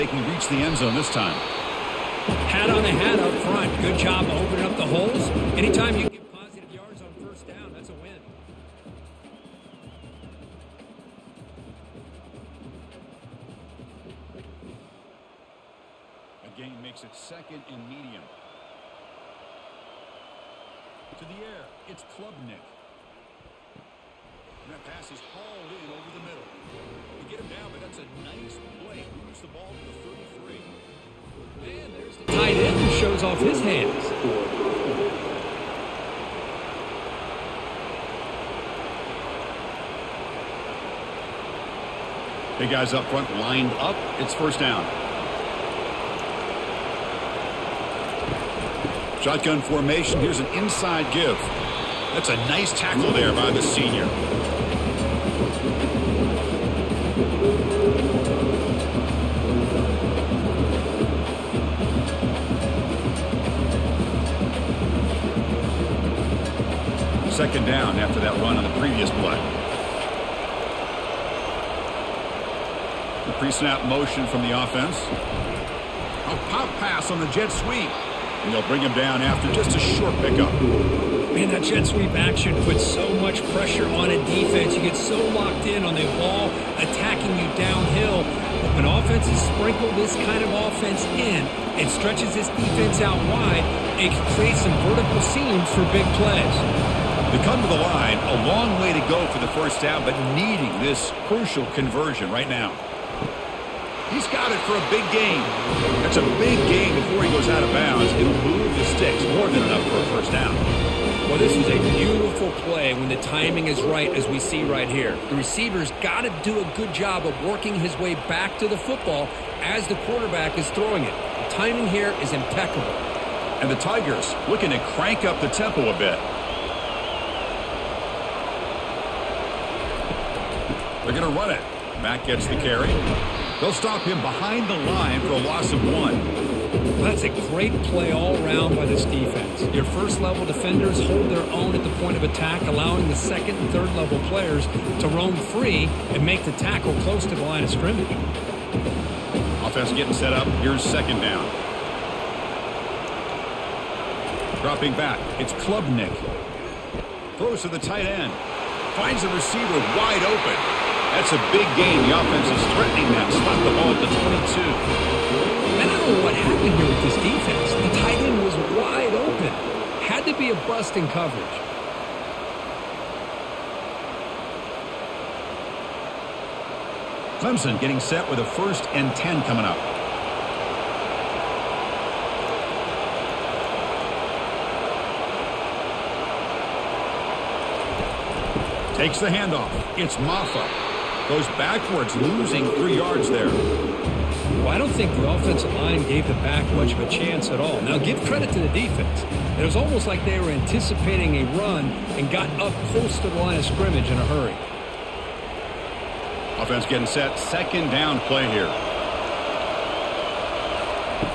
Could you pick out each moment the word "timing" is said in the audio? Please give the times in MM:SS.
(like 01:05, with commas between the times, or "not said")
01:53, 02:01.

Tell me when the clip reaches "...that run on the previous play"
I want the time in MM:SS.
01:08.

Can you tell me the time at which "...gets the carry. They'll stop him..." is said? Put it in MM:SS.
02:12.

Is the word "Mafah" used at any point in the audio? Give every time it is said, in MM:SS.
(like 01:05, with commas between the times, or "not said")
03:10.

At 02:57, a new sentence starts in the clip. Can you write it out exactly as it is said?
Clemson getting set with a first and 10 coming up.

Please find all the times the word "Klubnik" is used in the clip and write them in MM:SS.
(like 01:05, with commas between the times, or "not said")
00:22, 02:35.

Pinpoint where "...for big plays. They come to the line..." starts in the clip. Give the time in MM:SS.
01:35.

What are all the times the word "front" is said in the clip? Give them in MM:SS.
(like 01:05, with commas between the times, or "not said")
00:03, 00:43.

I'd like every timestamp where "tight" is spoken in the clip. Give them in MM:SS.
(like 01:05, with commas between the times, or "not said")
00:32, 02:37, 02:48.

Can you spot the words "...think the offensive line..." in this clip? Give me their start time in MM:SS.
03:14.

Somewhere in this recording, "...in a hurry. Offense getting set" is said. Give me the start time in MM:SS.
03:24.